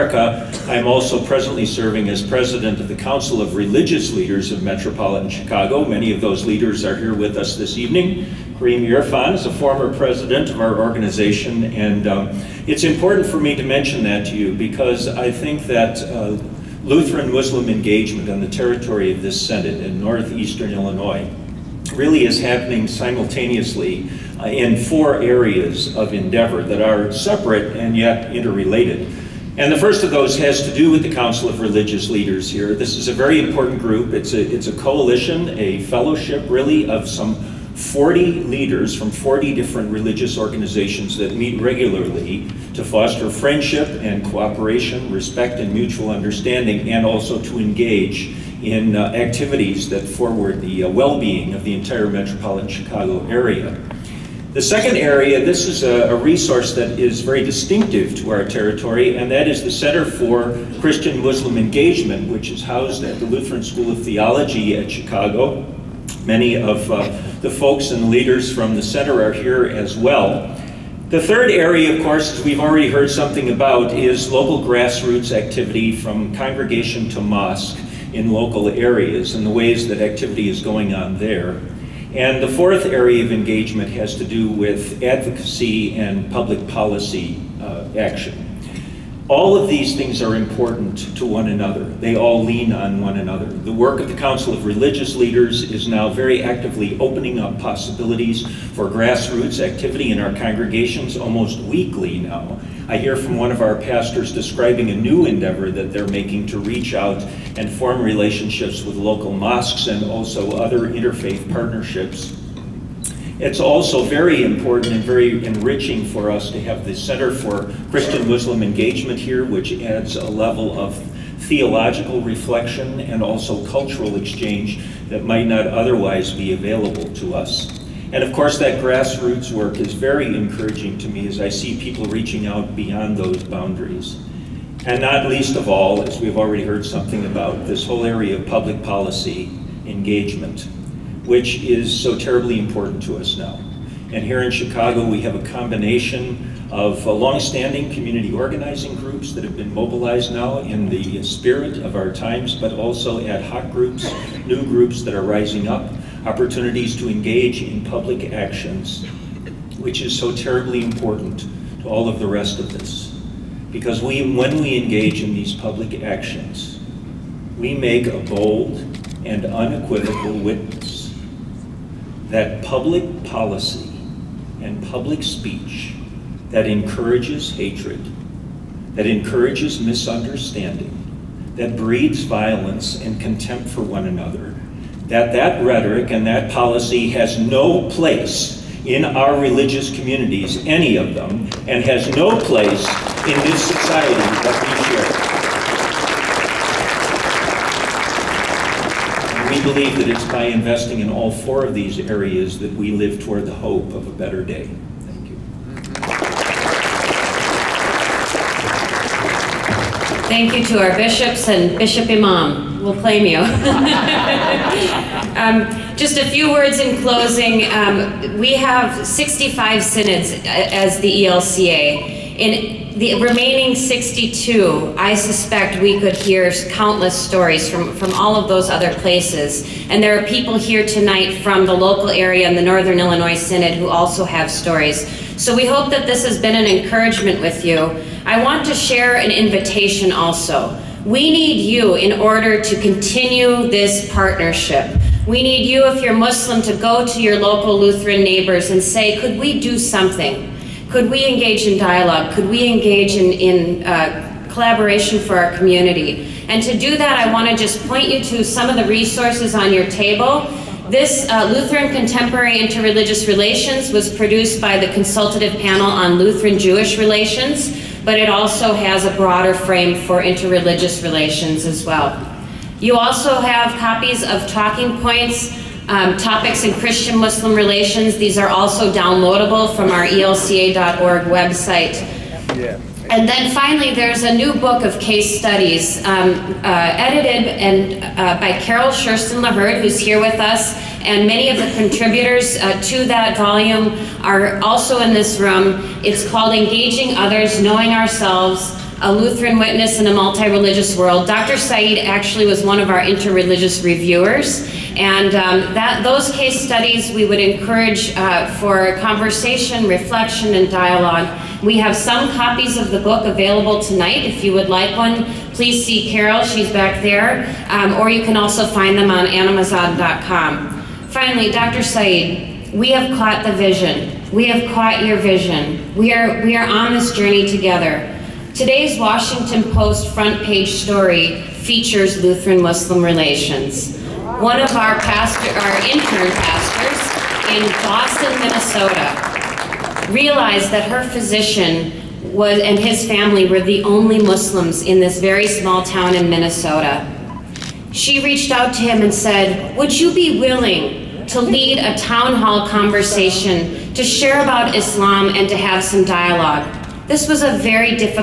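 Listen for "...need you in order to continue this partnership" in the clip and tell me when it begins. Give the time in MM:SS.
04:01.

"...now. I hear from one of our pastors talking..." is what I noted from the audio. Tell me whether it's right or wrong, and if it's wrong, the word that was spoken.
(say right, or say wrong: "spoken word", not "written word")
wrong: "describing", not "talking".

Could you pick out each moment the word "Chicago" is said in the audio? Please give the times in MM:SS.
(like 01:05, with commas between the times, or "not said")
00:05, 00:52, 01:04, 02:24.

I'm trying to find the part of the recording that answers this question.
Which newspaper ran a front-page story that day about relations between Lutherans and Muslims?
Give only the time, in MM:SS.
05:28.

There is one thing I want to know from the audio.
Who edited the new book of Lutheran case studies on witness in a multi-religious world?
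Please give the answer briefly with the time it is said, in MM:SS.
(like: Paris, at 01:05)
Carol Schersten LaHurd, at 04:48.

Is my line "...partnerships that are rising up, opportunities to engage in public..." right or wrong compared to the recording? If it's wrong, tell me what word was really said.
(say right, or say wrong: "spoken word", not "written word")
wrong: "groups", not "partnerships".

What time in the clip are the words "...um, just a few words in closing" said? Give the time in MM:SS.
03:35.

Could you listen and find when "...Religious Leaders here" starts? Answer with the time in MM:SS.
00:31.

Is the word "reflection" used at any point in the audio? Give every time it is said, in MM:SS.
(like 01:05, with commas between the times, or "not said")
02:02, 05:09.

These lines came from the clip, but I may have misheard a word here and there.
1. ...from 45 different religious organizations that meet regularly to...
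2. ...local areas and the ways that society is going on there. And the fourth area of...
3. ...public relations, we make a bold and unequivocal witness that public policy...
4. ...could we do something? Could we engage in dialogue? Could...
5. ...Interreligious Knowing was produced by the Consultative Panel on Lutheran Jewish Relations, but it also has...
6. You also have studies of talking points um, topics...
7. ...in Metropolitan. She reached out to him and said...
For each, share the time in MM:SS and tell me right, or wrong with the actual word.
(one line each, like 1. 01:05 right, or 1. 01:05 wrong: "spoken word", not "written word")
1. 00:38 wrong: "40", not "45"
2. 01:18 wrong: "activity", not "society"
3. 02:45 wrong: "actions", not "relations"
4. 04:09 right
5. 04:22 wrong: "Relations", not "Knowing"
6. 04:32 wrong: "copies", not "studies"
7. 05:46 wrong: "Minnesota", not "Metropolitan".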